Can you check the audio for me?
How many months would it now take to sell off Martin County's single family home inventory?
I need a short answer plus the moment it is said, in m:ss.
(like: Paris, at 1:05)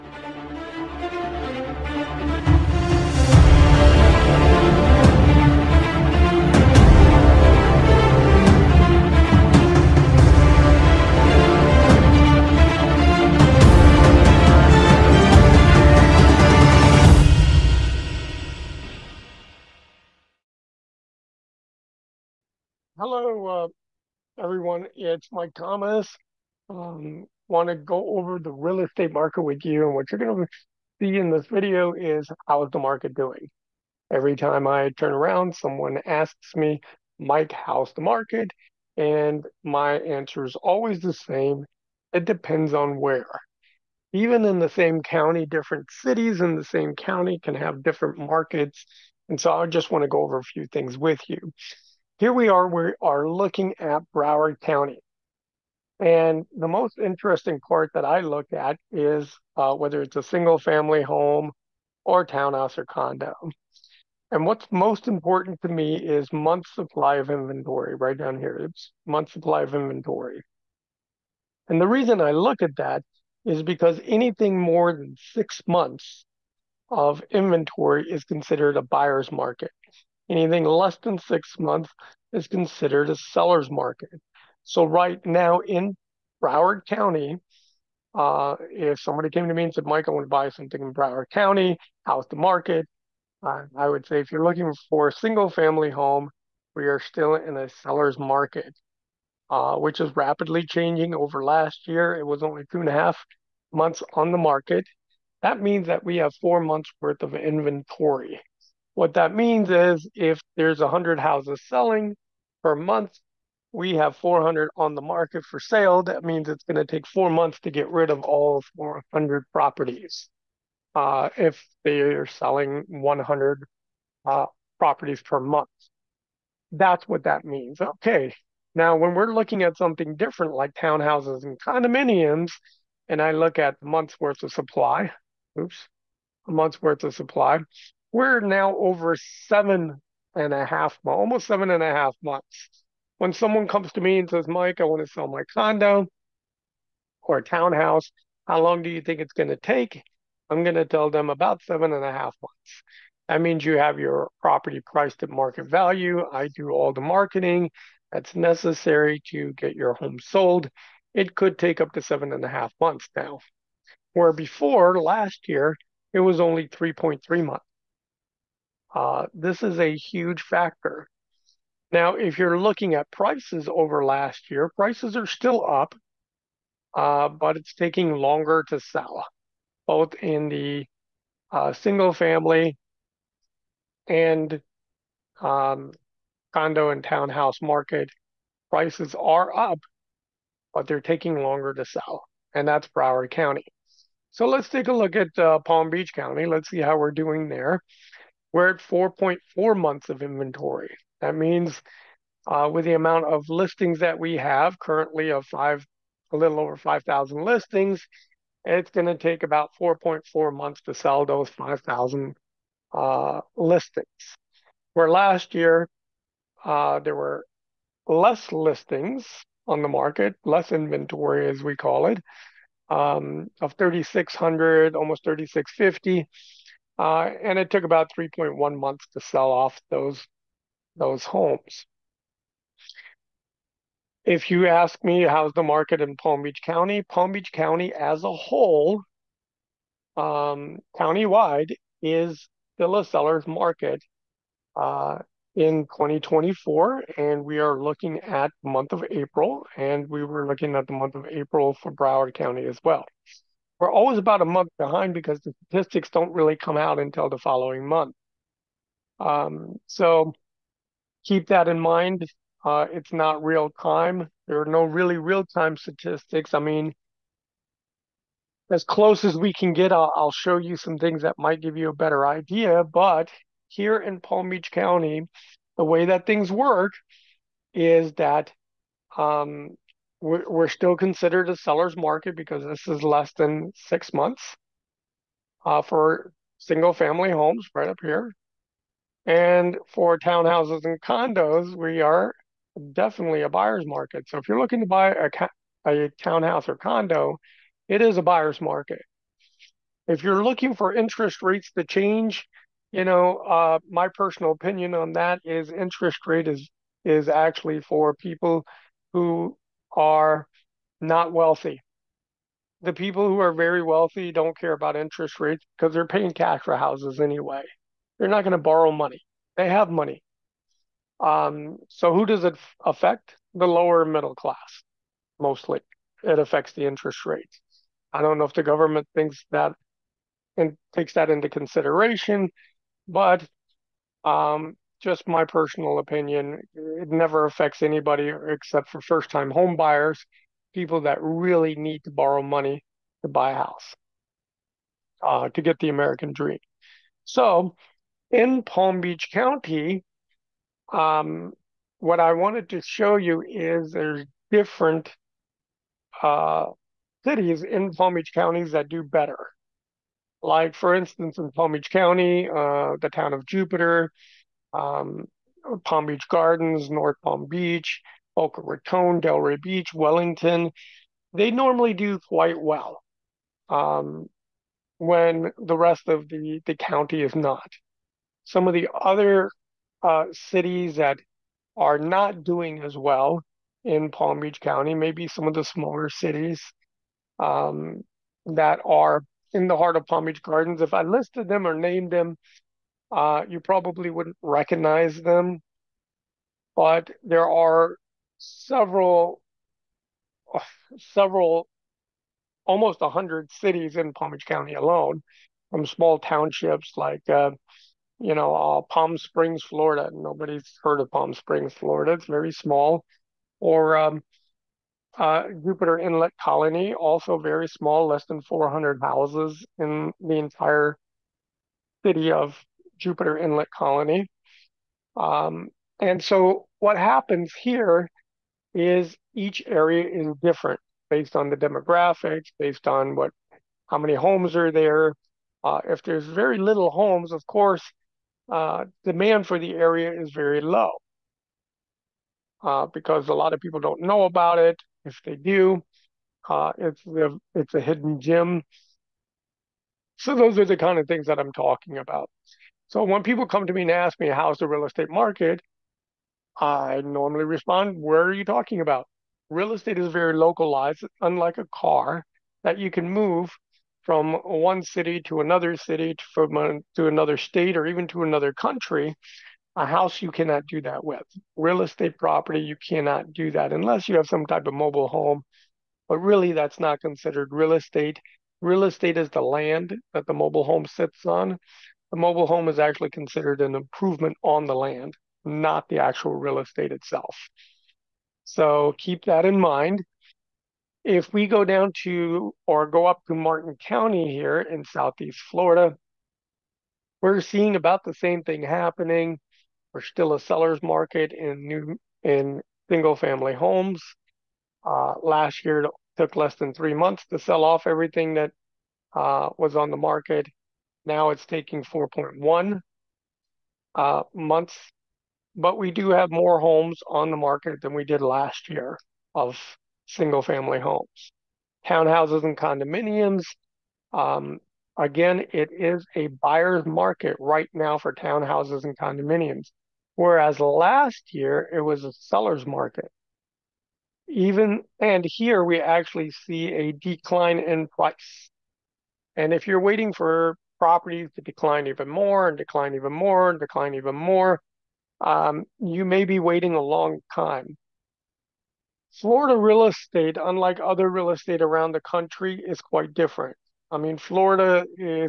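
4.1 months, at 8:31.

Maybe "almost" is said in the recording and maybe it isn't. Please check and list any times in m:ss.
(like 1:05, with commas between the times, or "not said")
2:21, 3:44, 6:42.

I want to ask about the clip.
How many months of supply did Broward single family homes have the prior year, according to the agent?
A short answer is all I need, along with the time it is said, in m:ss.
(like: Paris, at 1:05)
2.5 months, at 1:42.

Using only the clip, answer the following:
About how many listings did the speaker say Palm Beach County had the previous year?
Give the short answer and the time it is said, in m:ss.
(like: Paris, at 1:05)
3,650, at 3:45.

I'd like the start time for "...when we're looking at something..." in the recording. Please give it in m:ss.
2:08.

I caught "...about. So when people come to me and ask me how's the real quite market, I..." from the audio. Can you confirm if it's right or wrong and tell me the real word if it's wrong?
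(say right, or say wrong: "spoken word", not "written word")
wrong: "estate", not "quite".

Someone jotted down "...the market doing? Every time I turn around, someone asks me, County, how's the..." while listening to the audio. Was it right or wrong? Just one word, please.
wrong.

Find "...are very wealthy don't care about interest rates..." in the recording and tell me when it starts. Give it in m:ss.
5:13.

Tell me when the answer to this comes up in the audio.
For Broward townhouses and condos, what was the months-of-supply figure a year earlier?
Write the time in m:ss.
2:46.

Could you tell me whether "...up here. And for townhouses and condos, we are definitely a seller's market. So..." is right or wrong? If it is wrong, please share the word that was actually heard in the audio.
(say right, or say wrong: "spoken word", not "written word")
wrong: "buyer", not "seller".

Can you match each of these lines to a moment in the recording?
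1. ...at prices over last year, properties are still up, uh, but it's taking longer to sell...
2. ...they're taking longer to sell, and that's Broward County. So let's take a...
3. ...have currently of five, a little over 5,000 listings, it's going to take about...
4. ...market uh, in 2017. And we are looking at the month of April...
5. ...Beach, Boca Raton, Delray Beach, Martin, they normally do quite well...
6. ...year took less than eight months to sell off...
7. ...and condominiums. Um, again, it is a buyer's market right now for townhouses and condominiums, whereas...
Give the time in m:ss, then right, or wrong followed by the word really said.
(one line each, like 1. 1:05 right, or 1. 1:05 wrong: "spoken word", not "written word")
1. 2:52 wrong: "prices", not "properties"
2. 3:10 right
3. 3:24 right
4. 4:03 wrong: "2024", not "2017"
5. 6:07 wrong: "Wellington", not "Martin"
6. 8:25 wrong: "three", not "eight"
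7. 8:42 right.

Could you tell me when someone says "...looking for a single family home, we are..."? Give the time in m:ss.
1:34.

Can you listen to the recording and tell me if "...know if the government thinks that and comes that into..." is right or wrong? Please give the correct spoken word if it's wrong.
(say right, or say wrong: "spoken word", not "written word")
wrong: "takes", not "comes".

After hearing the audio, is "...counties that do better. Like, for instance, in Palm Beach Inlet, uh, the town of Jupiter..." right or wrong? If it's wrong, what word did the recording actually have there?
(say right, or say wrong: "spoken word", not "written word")
wrong: "County", not "Inlet".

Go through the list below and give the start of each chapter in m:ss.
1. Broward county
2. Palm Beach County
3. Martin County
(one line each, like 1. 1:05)
1. 0:22
2. 3:15
3. 8:13.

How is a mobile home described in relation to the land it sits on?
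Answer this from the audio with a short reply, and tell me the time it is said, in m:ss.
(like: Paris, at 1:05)
an improvement, at 8:03.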